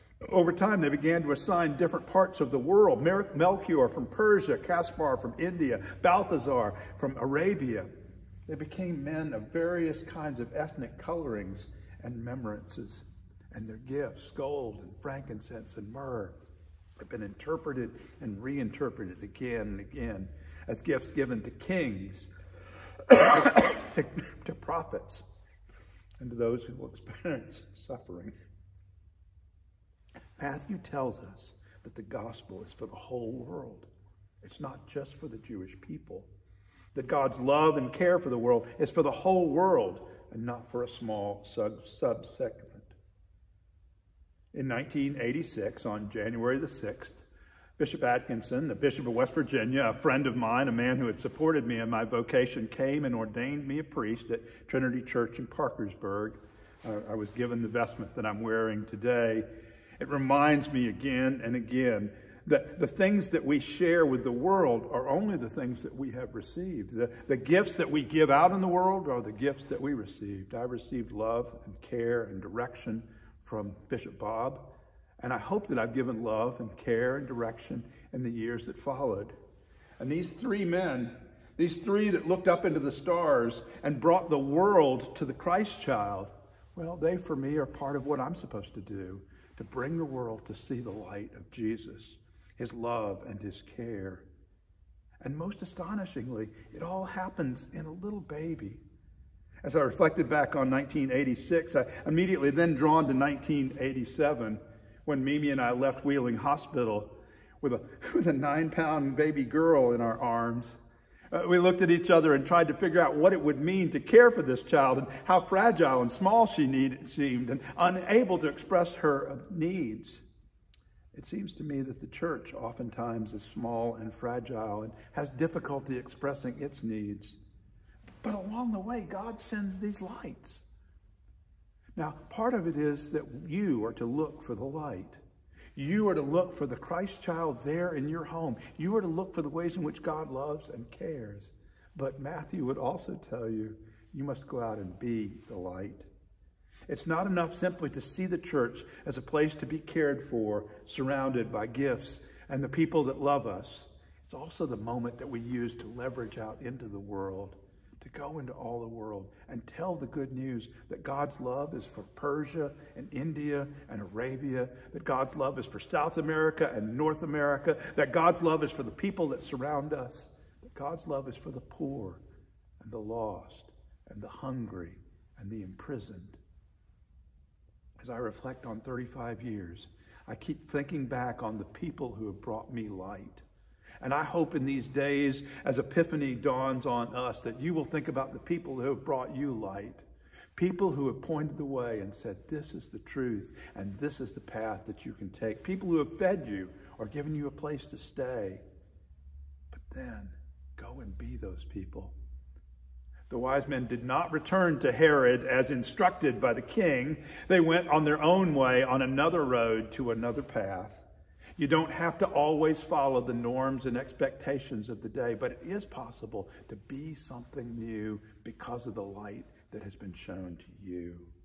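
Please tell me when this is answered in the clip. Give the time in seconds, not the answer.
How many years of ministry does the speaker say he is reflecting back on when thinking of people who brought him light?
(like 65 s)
178 s.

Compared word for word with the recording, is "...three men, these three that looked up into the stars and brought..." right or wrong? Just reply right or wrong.
right.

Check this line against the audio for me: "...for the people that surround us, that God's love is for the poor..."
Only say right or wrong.
right.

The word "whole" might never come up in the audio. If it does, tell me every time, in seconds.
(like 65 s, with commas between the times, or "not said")
32 s, 39 s.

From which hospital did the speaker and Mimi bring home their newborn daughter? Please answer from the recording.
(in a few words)
Wheeling Hospital.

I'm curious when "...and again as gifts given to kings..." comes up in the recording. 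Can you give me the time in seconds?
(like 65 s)
19 s.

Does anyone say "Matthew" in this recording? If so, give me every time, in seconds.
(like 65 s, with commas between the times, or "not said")
30 s, 142 s.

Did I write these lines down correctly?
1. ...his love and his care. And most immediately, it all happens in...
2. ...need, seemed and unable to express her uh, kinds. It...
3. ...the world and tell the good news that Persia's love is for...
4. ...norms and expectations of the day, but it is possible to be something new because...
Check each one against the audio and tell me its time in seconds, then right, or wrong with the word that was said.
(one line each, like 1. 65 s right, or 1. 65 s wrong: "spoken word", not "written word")
1. 92 s wrong: "astonishingly", not "immediately"
2. 116 s wrong: "needs", not "kinds"
3. 158 s wrong: "God", not "Persia"
4. 213 s right.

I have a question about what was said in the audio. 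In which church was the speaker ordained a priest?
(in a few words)
Trinity Church in Parkersburg.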